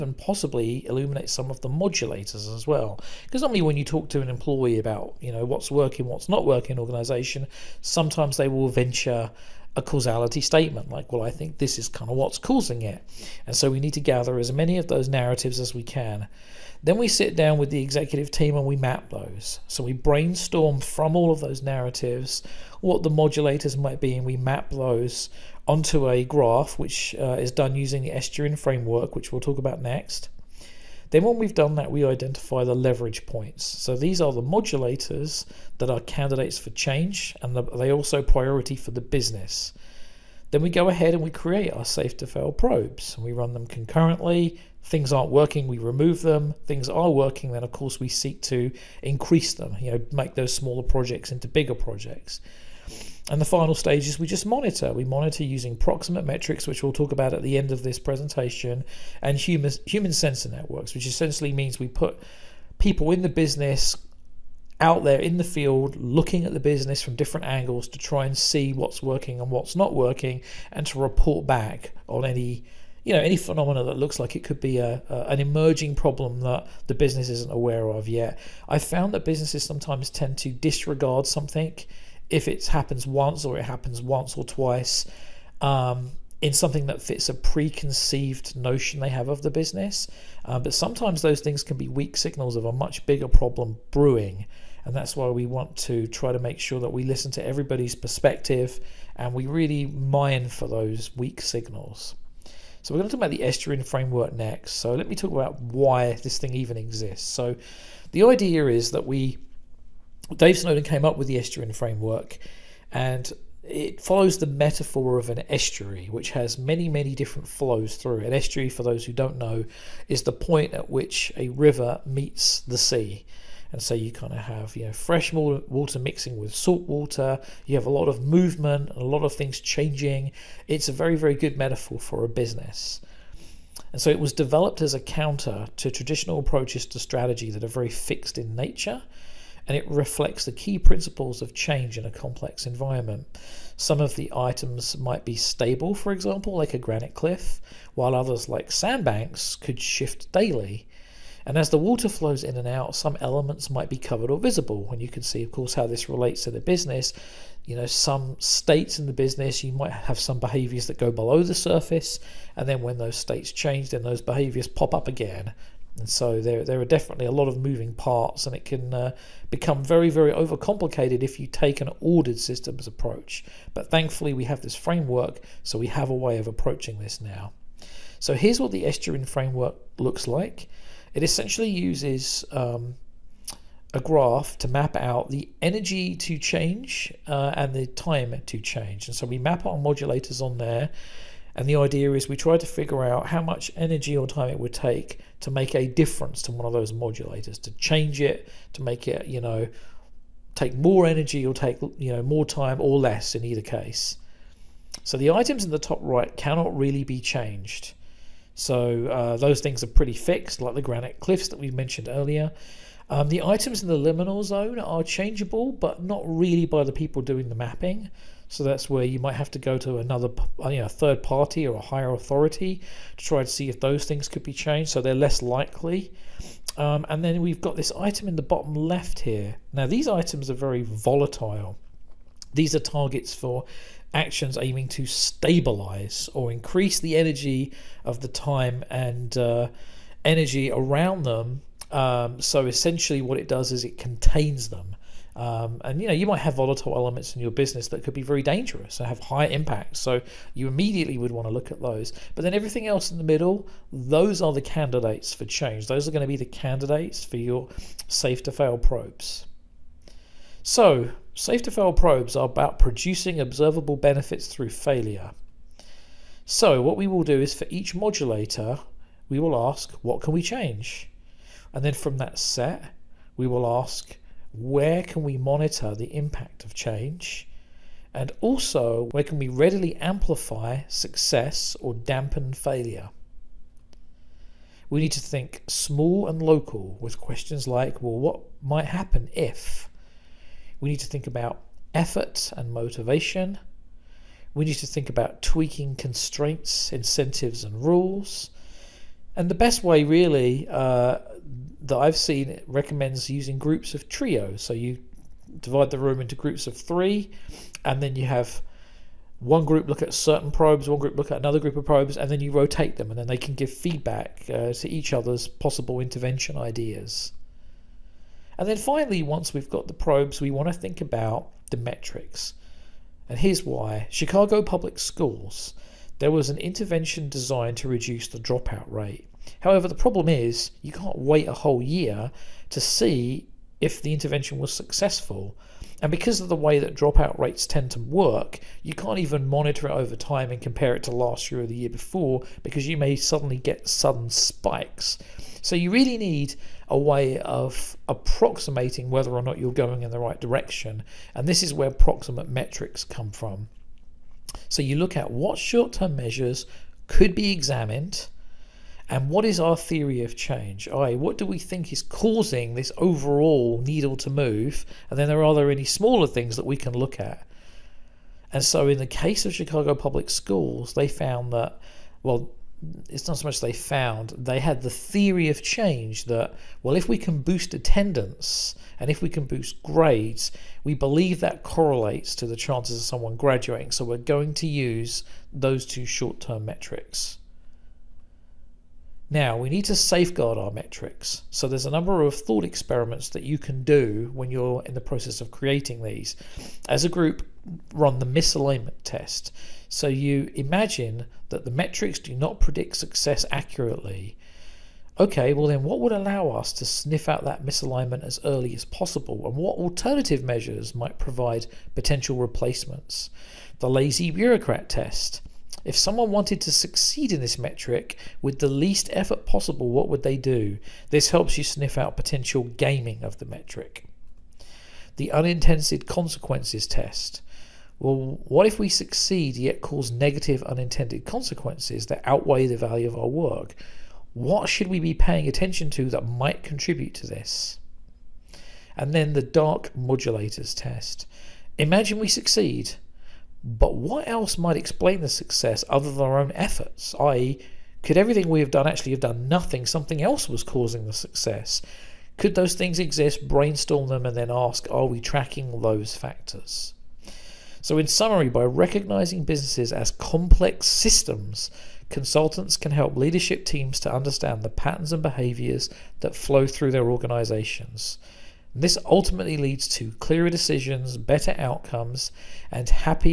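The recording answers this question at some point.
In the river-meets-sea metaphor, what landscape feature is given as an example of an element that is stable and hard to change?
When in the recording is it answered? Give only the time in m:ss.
2:26.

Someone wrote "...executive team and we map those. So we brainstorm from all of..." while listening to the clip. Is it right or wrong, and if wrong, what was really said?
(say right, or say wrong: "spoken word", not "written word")
right.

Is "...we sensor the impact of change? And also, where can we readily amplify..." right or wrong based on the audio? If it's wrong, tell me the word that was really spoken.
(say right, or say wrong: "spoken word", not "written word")
wrong: "monitor", not "sensor".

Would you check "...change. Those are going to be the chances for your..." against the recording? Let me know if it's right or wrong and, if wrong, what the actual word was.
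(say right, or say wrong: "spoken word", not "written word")
wrong: "candidates", not "chances".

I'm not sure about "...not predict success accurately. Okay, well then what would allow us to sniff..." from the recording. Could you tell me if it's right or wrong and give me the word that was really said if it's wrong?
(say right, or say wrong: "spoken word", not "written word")
right.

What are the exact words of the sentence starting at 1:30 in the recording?
Uh, but sometimes those things can be weak signals of a much bigger problem brewing.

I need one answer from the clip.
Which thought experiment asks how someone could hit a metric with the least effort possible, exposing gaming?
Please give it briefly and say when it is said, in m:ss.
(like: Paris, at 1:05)
lazy bureaucrat test, at 6:53.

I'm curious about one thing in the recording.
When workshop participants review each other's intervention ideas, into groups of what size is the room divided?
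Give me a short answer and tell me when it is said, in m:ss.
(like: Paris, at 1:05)
3, at 5:06.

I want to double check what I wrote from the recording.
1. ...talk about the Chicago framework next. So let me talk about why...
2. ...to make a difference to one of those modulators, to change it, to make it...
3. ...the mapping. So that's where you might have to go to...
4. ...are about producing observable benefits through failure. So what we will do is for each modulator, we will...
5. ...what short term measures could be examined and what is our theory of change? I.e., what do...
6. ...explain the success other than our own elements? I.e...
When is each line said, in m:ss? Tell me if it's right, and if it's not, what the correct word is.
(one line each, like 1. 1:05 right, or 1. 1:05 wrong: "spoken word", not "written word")
1. 1:43 wrong: "Estuarine", not "Chicago"
2. 3:15 right
3. 3:37 right
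4. 4:22 right
5. 5:55 right
6. 7:24 wrong: "efforts", not "elements".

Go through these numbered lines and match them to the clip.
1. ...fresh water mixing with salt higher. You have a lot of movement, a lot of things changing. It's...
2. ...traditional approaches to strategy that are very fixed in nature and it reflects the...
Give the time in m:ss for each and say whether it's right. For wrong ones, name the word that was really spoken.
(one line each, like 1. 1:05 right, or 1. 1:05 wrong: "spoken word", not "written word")
1. 2:04 wrong: "water", not "higher"
2. 2:15 right.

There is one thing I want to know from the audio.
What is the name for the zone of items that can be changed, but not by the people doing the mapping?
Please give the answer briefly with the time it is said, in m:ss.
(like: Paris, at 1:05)
liminal zone, at 3:33.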